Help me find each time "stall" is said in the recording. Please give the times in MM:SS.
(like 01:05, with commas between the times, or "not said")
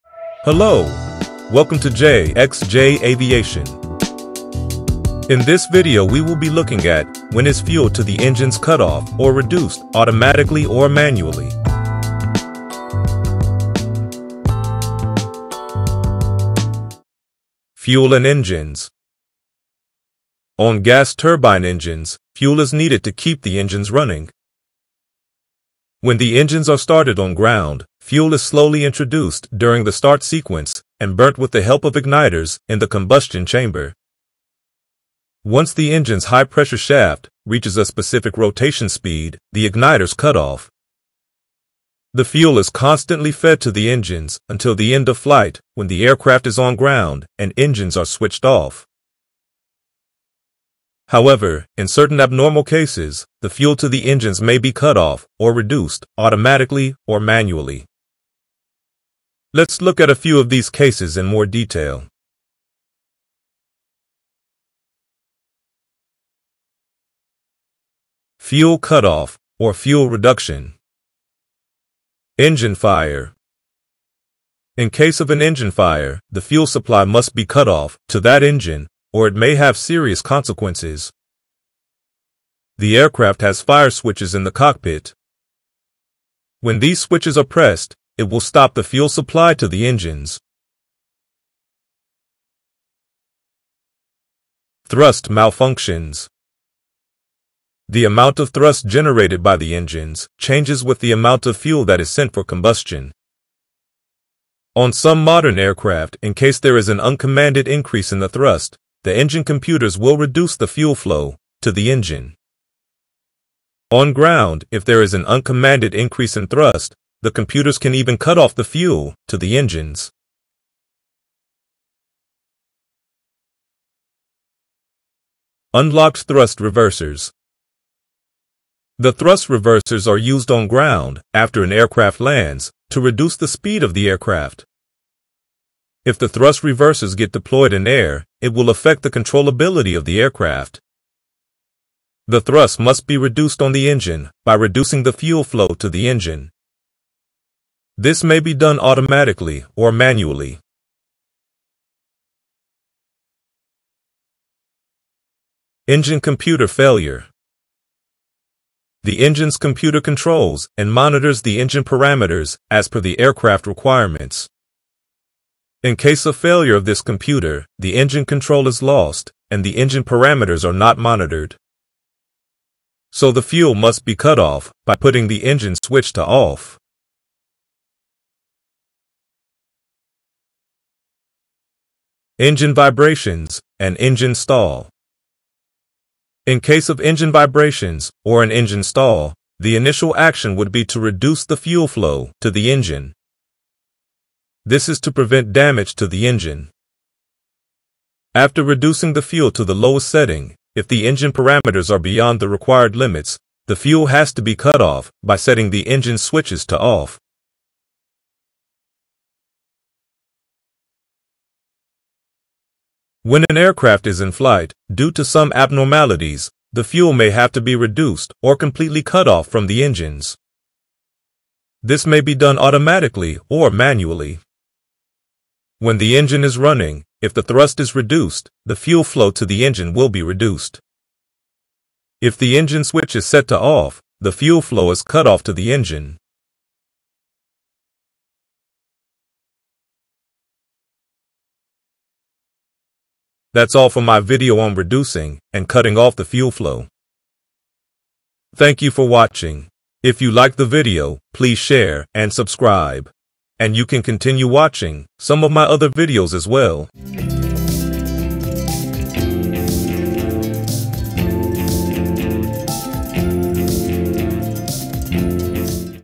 03:04, 03:08.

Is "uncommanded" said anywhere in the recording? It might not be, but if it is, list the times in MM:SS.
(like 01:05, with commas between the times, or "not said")
01:47, 01:55.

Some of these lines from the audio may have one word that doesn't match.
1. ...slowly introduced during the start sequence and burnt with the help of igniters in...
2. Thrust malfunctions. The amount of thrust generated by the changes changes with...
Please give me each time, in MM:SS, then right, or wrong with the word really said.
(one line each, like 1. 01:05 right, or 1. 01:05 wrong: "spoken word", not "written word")
1. 00:28 right
2. 01:34 wrong: "engines", not "changes".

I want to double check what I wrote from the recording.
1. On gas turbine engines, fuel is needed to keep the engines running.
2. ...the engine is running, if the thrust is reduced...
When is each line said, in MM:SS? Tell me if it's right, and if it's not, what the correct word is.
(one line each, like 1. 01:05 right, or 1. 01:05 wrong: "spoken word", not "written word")
1. 00:20 right
2. 03:45 right.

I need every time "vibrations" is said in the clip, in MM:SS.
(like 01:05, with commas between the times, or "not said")
03:02, 03:07.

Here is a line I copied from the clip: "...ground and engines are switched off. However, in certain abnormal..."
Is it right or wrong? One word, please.
right.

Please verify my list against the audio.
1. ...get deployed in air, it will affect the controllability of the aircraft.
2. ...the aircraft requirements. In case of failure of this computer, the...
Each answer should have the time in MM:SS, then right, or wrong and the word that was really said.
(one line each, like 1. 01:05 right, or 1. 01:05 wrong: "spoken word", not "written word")
1. 02:17 right
2. 02:43 right.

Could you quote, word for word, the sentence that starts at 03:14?
This is to prevent damage to the engine.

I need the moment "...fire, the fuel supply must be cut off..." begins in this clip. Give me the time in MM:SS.
01:15.